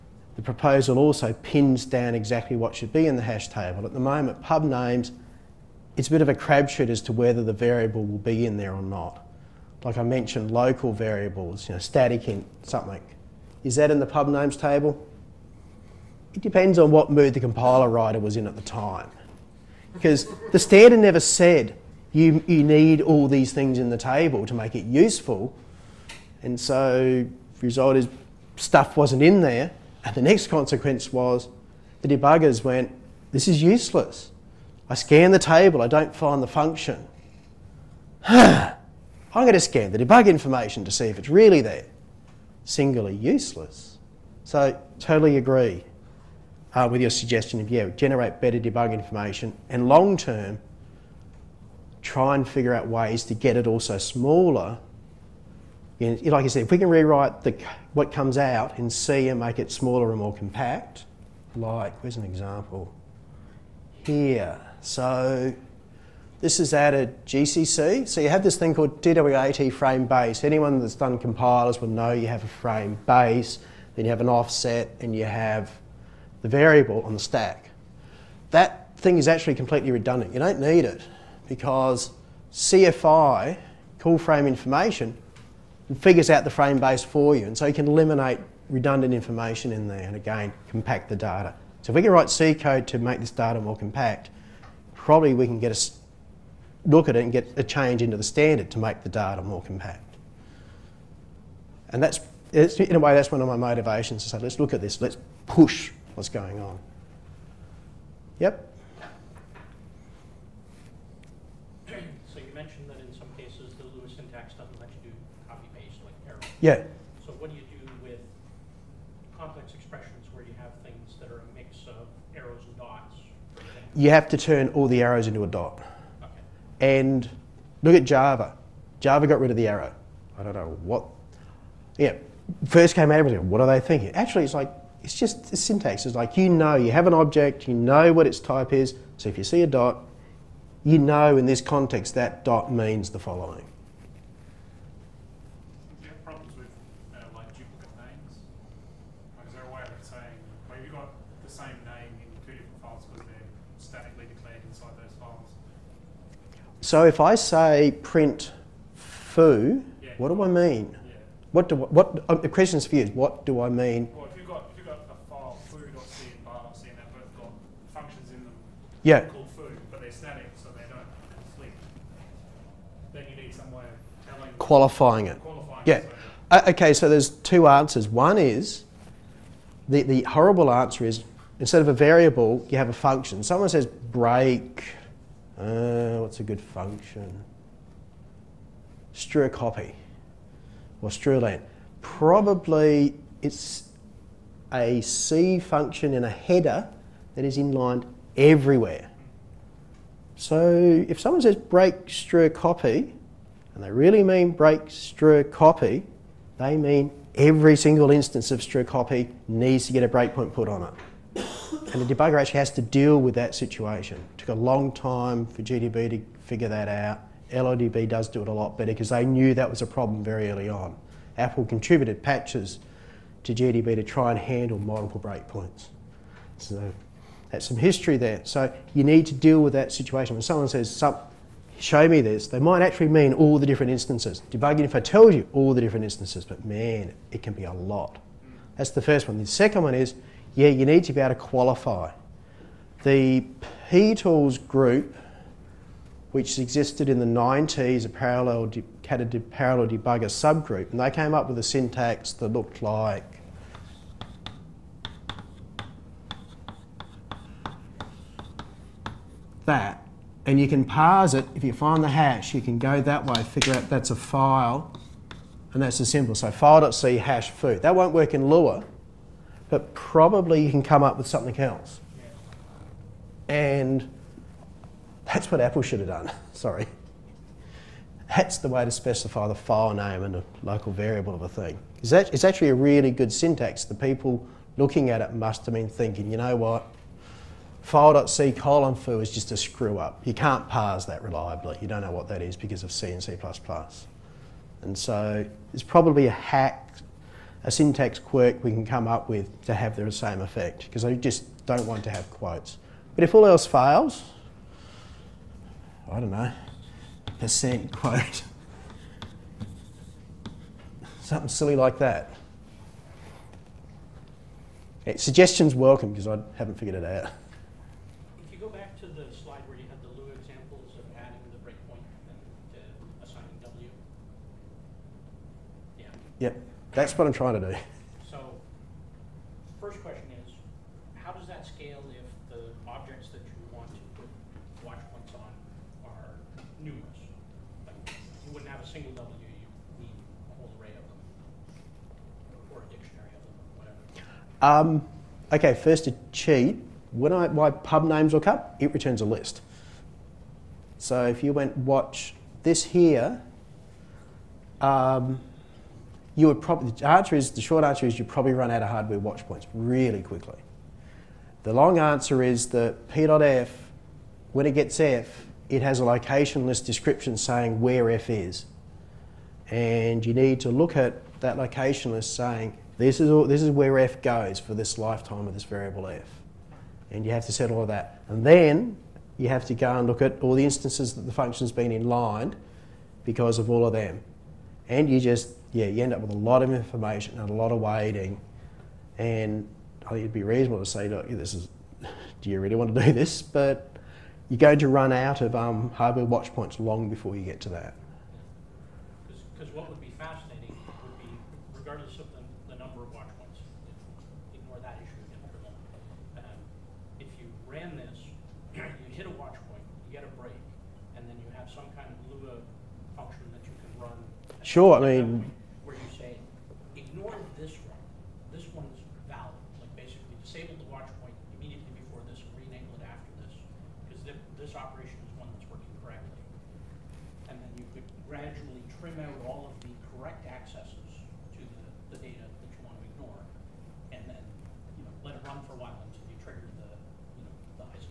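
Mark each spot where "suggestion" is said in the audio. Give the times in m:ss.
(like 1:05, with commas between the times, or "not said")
0:47, 5:15.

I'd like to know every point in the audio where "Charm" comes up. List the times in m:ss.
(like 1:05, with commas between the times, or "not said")
not said.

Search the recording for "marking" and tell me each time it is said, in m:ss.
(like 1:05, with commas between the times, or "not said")
not said.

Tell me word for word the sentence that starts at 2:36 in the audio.
So if I say print foo, yeah.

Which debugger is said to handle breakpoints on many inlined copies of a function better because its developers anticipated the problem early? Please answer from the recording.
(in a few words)
LLDB.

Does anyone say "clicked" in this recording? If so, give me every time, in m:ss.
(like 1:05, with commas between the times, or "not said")
not said.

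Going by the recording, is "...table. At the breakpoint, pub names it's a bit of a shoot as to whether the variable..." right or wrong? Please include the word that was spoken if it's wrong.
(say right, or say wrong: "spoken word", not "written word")
wrong: "moment", not "breakpoint".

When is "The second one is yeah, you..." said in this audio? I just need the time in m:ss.
3:59.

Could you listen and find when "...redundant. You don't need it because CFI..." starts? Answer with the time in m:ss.
1:19.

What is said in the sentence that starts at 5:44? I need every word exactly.
Um, okay, first to cheat, when I, my pub names look up, it returns a list.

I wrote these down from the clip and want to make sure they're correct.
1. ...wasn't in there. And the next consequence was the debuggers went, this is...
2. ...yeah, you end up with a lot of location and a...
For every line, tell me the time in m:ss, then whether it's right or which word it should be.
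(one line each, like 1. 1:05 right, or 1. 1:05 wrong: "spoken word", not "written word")
1. 0:28 right
2. 6:25 wrong: "information", not "location".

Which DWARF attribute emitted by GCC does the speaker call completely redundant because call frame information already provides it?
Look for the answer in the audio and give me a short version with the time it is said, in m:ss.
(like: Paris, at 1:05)
DW_AT frame base, at 1:09.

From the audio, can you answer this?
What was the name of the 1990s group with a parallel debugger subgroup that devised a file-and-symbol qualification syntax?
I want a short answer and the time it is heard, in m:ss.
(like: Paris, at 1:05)
P Tools, at 4:03.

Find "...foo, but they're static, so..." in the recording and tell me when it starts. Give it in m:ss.
2:49.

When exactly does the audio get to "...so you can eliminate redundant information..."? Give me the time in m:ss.
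1:27.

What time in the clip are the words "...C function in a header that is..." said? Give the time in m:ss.
3:15.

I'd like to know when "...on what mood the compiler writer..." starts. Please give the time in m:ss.
0:16.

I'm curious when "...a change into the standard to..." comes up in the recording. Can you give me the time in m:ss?
1:37.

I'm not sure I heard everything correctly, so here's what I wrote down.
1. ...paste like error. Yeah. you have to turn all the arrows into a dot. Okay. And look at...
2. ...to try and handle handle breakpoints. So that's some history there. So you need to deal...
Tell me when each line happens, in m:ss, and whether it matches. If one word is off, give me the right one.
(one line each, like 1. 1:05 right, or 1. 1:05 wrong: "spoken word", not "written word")
1. 1:55 right
2. 3:43 wrong: "multiple", not "handle".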